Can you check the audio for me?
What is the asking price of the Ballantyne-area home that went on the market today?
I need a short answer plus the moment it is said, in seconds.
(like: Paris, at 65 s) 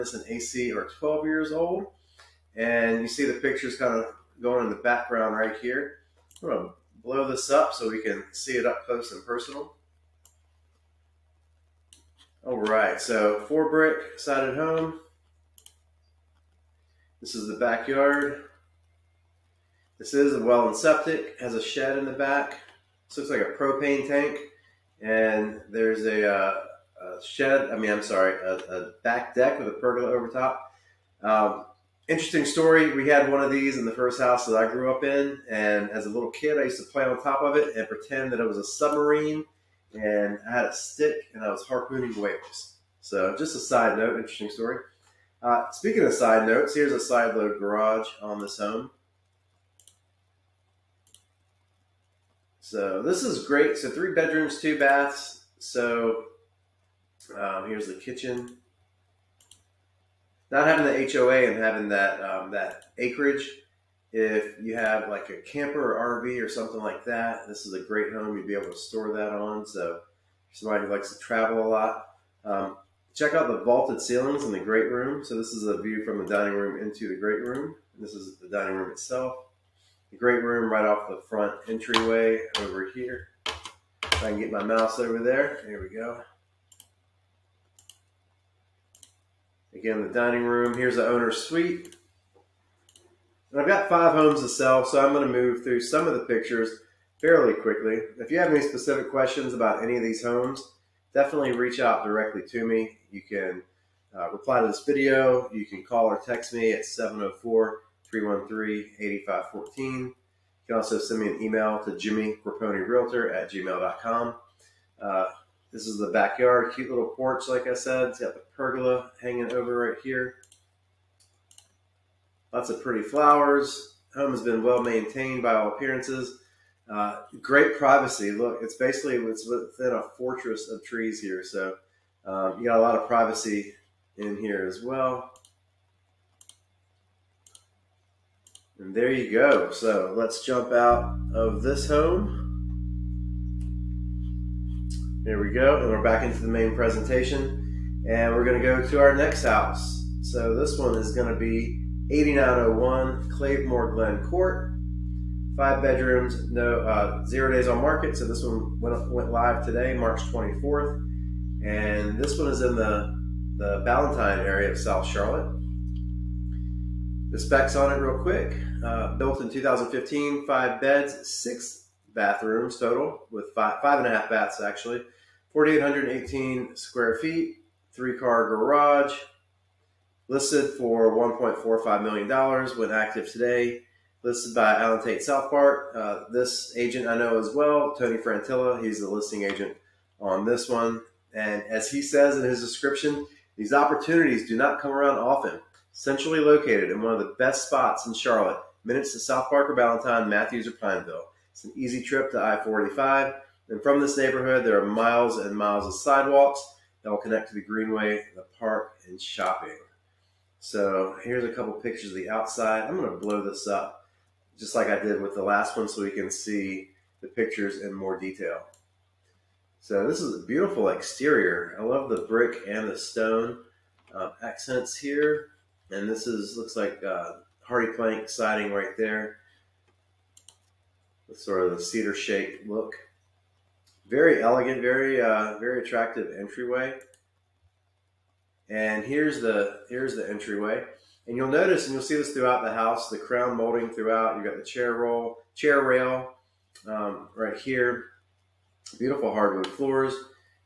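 $1.45 million, at 181 s.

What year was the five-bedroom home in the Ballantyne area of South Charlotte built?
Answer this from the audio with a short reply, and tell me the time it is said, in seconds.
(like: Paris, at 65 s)
2015, at 169 s.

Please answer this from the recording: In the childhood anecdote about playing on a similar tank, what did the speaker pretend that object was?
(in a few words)
a submarine.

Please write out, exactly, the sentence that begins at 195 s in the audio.
Centrally located in one of the best spots in Charlotte, minutes to South Park or Ballantyne, Matthews or Pineville.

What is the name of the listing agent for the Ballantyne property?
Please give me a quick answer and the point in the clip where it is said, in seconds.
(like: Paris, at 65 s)
Tony Frantilla, at 187 s.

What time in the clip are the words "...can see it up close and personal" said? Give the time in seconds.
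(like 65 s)
8 s.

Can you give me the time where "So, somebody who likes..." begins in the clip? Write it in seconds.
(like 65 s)
69 s.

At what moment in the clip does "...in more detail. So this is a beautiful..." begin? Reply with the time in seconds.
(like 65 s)
217 s.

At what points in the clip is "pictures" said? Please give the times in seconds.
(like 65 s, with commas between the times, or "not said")
3 s, 96 s, 211 s, 217 s.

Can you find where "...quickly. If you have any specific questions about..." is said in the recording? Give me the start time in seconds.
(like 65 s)
97 s.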